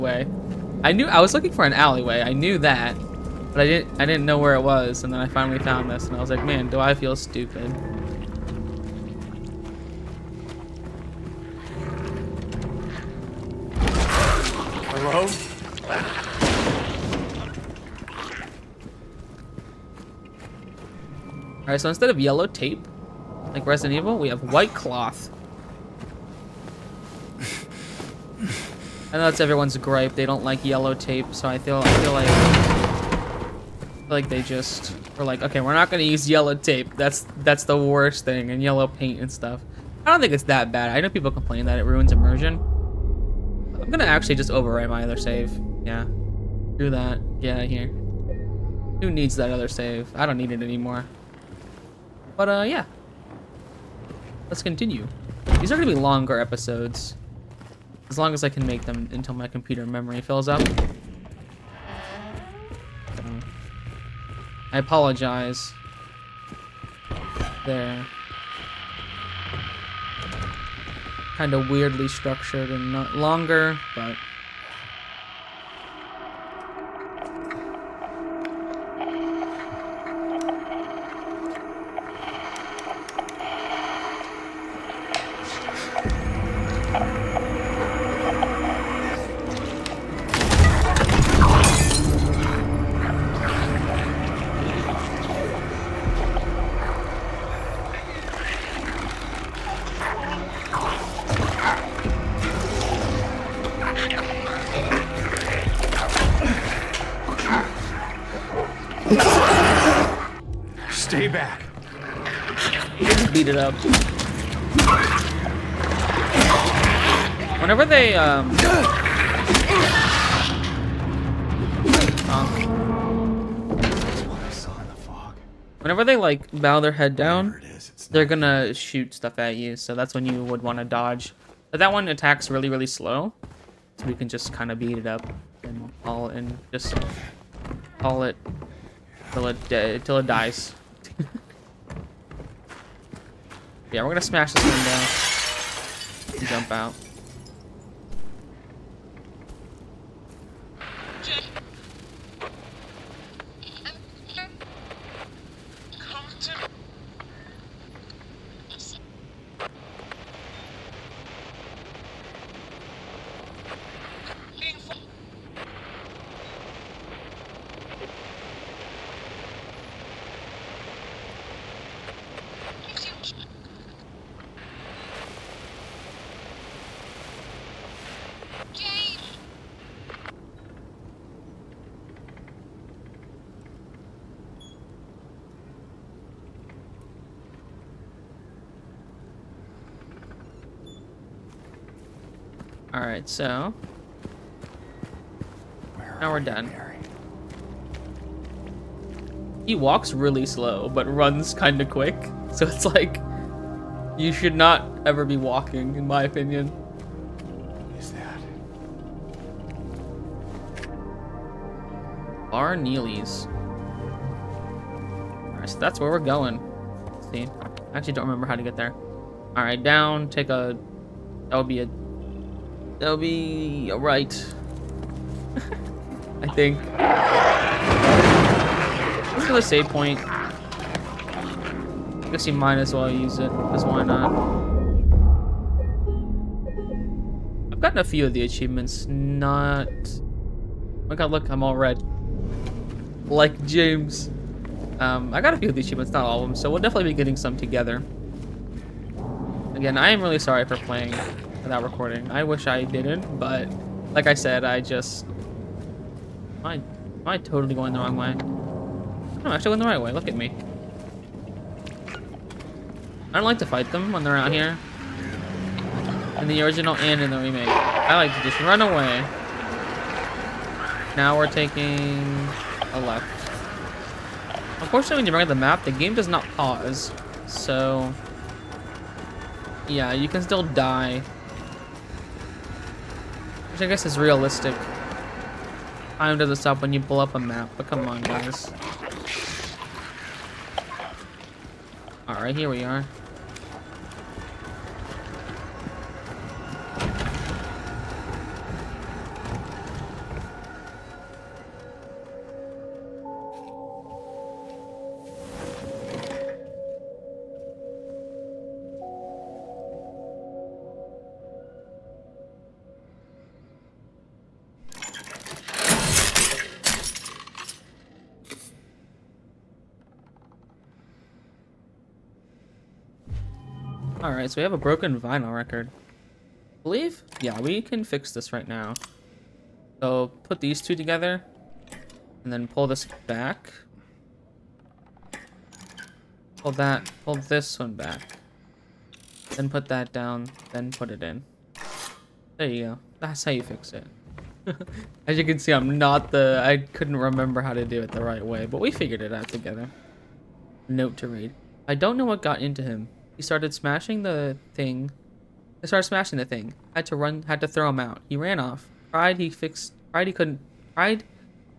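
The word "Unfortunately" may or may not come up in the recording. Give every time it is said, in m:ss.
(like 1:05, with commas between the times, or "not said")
4:34.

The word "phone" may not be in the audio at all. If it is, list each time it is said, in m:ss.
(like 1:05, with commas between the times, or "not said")
not said.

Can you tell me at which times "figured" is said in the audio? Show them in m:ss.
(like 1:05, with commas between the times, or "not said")
5:48.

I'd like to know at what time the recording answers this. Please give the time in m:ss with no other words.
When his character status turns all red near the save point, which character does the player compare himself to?
4:03.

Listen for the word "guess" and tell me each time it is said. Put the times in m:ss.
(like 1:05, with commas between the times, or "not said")
3:52, 4:43.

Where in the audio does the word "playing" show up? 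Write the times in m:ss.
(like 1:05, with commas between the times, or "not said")
4:10.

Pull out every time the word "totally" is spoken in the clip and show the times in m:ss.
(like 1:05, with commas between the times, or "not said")
4:17.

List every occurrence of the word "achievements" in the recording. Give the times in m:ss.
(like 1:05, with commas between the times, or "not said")
3:58, 4:05.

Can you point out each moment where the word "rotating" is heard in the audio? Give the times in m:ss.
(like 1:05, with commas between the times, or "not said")
not said.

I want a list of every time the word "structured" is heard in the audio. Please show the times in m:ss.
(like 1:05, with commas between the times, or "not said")
1:12.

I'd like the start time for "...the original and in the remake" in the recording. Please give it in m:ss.
4:26.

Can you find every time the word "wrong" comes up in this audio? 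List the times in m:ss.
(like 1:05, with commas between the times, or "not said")
4:17.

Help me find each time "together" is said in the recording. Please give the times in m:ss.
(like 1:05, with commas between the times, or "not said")
4:07, 5:30, 5:49.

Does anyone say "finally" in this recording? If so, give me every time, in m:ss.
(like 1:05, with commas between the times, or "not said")
0:05.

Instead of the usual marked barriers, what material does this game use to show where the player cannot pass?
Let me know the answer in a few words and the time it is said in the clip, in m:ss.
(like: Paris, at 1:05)
White cloth, at 0:24.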